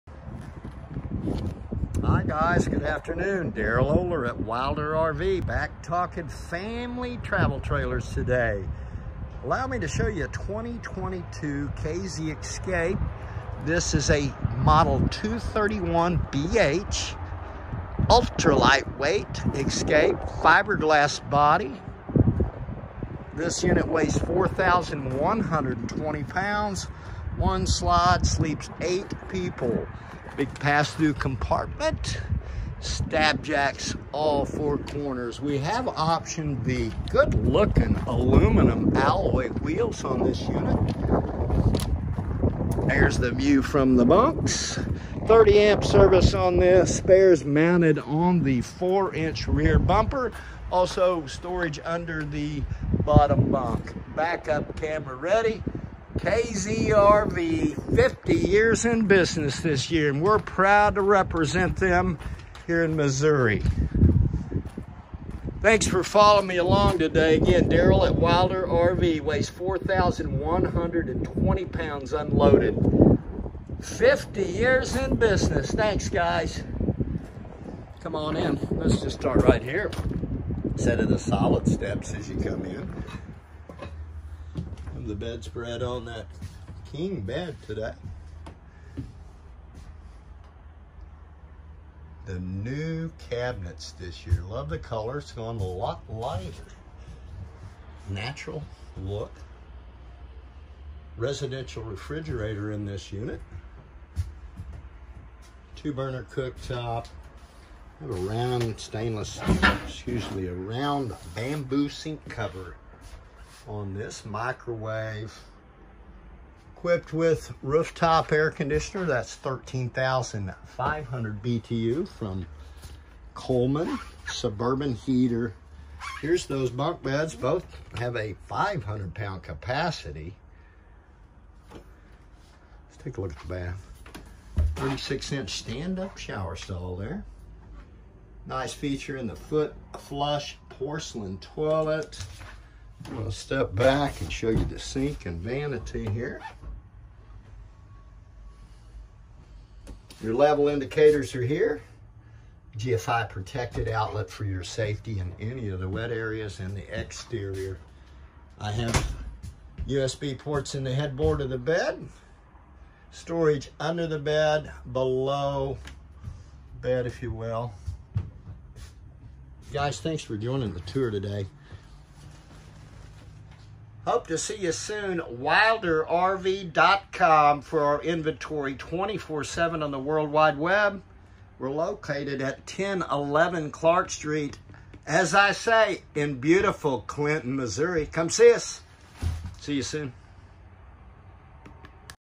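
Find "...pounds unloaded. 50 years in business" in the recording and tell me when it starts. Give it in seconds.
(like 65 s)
71 s.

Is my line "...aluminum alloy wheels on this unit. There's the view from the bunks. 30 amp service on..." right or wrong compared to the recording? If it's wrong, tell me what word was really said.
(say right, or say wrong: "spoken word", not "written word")
right.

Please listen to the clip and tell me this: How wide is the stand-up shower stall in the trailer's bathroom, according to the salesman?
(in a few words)
36 inch.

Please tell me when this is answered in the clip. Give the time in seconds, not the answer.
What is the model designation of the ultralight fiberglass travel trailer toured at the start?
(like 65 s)
15 s.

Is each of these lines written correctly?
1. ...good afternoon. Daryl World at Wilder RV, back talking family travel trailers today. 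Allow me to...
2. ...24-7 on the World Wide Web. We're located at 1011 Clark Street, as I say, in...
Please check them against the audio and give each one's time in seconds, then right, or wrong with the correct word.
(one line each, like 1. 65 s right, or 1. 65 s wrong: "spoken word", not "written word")
1. 2 s wrong: "Oler", not "World"
2. 178 s right.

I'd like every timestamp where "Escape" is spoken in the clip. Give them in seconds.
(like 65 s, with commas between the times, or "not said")
12 s, 19 s.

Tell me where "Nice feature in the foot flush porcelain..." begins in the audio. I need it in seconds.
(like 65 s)
138 s.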